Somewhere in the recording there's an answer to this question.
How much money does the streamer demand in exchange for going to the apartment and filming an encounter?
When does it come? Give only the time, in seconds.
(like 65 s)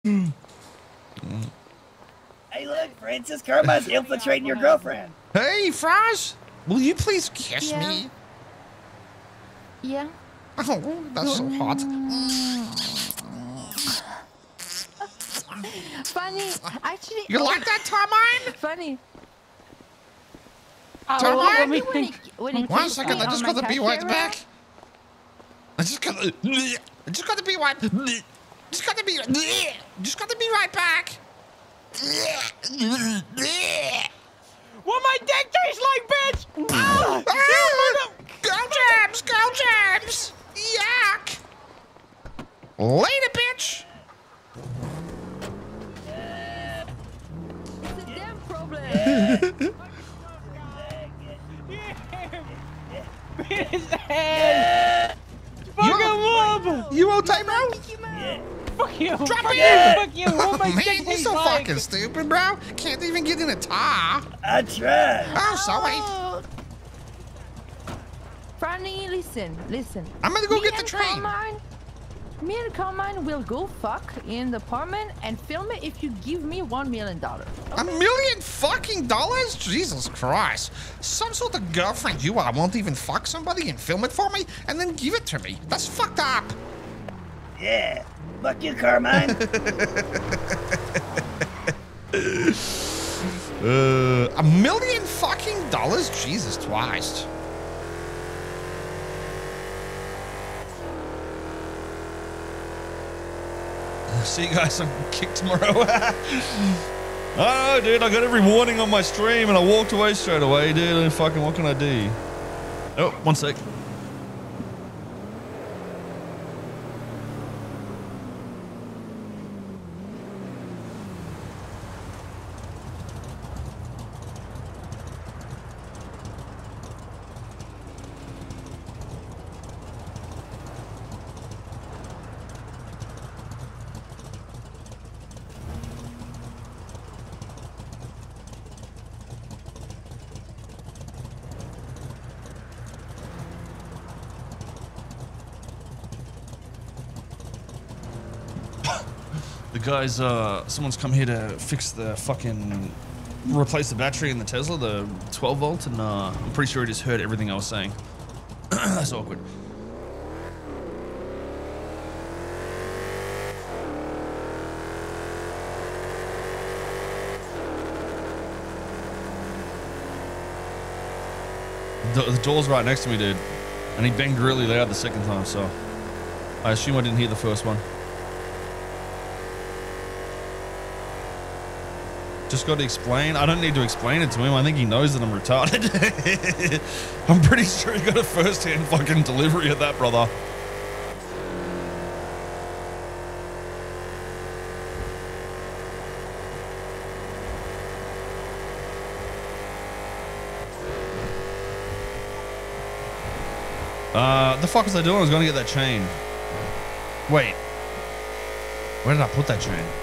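76 s.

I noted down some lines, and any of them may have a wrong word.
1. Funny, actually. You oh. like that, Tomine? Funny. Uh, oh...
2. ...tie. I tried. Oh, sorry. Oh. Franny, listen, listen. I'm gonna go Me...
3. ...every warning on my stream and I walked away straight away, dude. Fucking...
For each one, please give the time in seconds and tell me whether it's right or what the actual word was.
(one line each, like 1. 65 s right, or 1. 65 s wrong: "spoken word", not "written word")
1. 16 s right
2. 63 s right
3. 108 s right.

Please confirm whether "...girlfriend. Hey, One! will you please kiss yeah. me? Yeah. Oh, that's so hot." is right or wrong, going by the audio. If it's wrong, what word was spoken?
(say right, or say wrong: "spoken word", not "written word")
wrong: "Fraz", not "One".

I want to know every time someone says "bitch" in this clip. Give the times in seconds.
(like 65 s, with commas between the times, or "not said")
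36 s, 43 s.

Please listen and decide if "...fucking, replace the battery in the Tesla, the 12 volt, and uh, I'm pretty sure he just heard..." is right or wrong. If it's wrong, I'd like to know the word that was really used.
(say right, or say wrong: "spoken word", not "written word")
right.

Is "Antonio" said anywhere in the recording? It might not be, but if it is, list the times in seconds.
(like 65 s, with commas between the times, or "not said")
not said.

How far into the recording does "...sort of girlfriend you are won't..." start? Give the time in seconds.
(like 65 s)
81 s.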